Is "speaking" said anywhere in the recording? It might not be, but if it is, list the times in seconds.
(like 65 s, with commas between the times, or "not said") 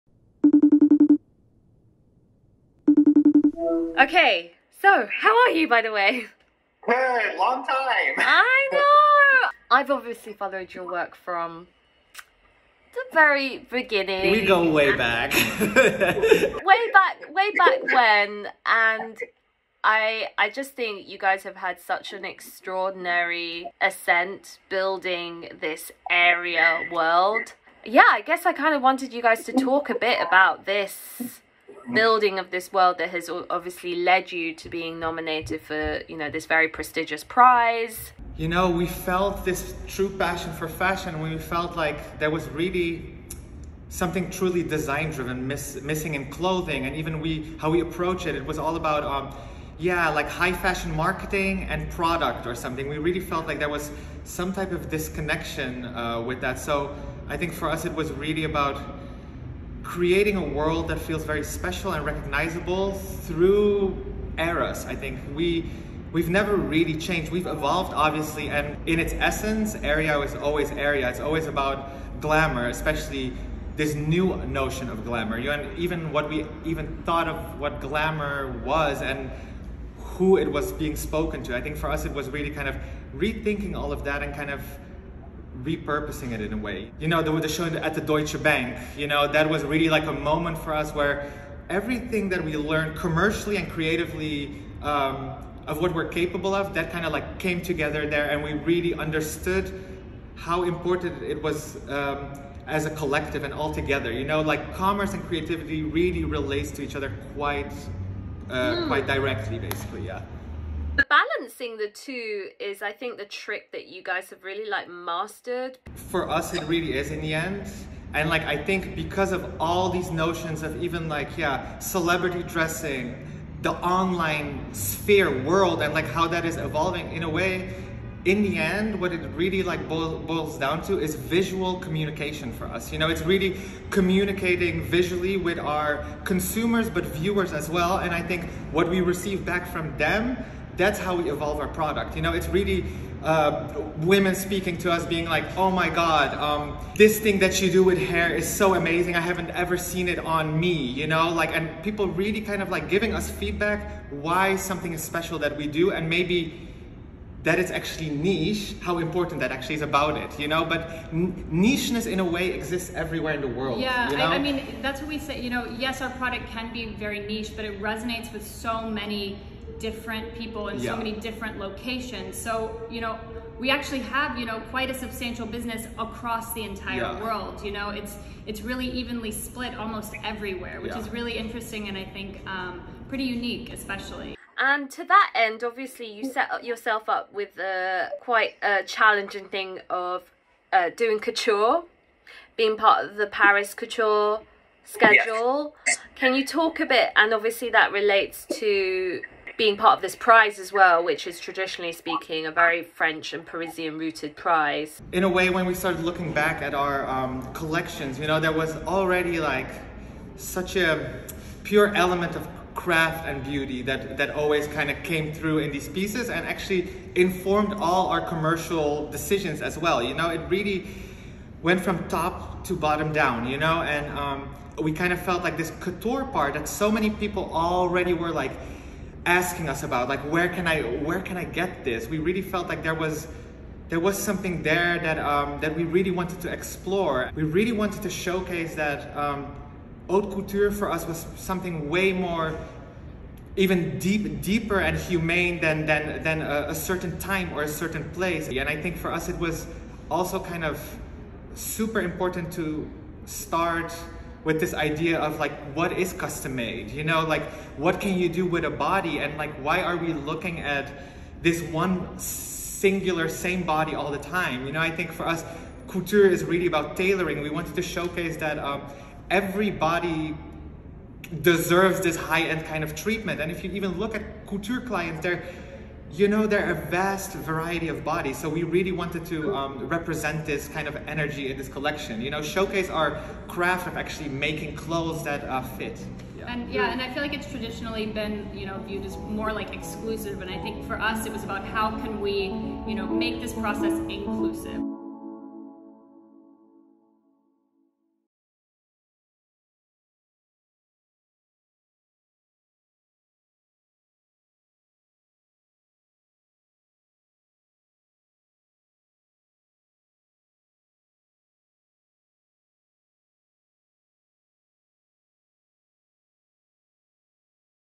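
144 s, 201 s.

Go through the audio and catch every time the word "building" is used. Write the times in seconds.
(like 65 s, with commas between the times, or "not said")
24 s, 31 s.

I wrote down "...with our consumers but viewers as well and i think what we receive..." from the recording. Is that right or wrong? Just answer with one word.
right.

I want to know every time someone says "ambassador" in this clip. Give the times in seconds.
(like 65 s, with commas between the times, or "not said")
not said.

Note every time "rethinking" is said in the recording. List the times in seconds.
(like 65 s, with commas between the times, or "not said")
83 s.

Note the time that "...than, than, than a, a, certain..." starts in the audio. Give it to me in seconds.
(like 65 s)
245 s.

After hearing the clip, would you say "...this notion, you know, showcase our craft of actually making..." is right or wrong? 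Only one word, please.
wrong.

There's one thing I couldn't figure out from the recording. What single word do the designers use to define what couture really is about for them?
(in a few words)
tailoring.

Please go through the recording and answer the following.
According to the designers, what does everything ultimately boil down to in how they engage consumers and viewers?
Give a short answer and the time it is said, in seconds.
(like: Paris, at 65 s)
visual communication, at 131 s.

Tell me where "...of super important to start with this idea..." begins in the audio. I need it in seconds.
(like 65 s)
250 s.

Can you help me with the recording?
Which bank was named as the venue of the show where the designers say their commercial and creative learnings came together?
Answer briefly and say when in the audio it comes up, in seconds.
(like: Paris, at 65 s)
Deutsche Bank, at 88 s.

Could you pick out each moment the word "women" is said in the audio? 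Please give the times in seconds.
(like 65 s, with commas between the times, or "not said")
143 s.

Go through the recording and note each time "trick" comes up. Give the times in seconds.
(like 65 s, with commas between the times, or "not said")
113 s.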